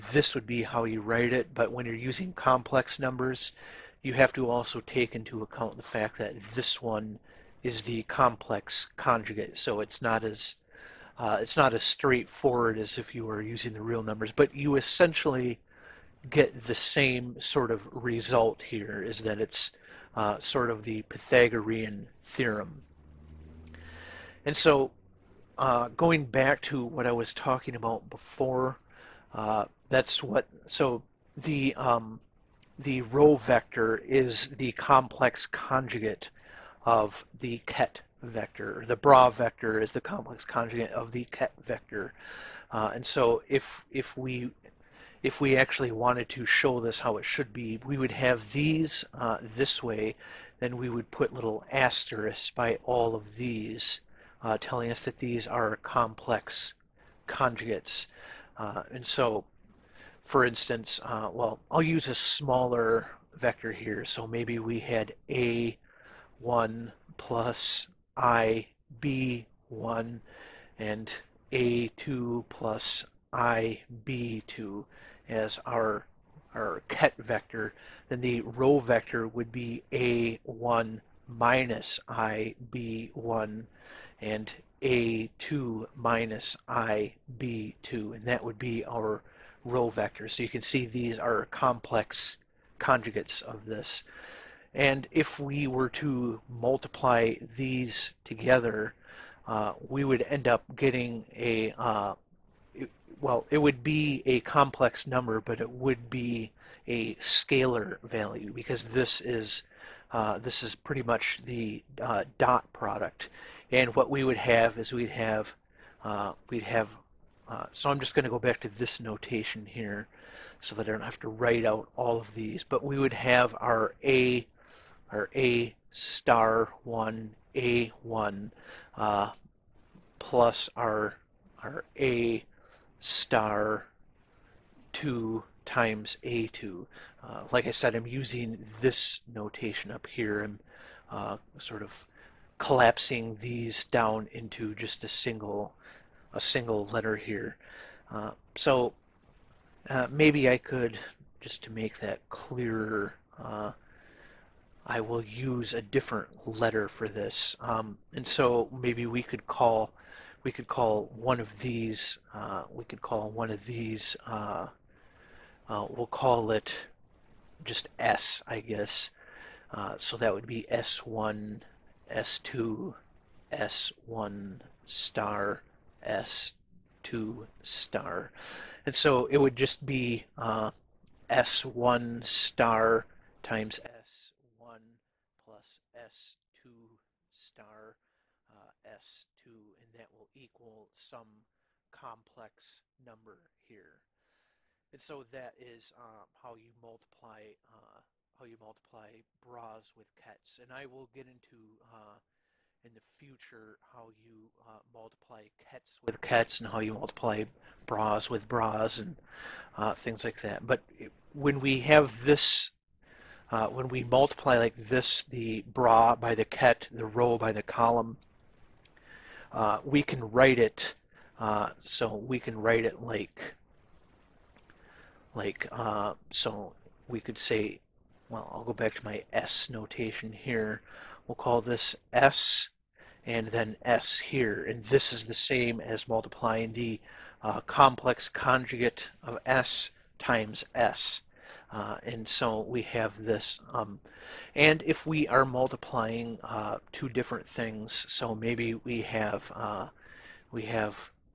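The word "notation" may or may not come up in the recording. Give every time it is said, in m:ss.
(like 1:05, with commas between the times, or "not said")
1:58, 2:19, 3:49.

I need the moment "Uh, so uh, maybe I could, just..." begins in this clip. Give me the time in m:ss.
2:28.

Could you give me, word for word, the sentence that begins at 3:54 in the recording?
And this is the same as multiplying the uh, complex conjugate of s times s.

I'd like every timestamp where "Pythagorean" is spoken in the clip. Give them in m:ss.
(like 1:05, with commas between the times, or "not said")
0:21.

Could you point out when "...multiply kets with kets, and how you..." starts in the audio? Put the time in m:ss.
3:24.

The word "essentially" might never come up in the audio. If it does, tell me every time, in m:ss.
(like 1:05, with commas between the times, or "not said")
0:14.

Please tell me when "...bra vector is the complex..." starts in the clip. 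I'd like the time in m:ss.
0:38.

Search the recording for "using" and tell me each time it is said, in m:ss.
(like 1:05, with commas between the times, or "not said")
0:01, 0:13, 2:18.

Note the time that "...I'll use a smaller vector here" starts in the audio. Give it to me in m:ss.
1:01.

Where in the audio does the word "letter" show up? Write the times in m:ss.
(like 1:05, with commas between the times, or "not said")
2:26, 2:36.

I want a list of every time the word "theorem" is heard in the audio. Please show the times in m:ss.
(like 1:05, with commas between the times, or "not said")
0:22.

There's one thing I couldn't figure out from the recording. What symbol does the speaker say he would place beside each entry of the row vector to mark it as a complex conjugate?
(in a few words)
asterisks.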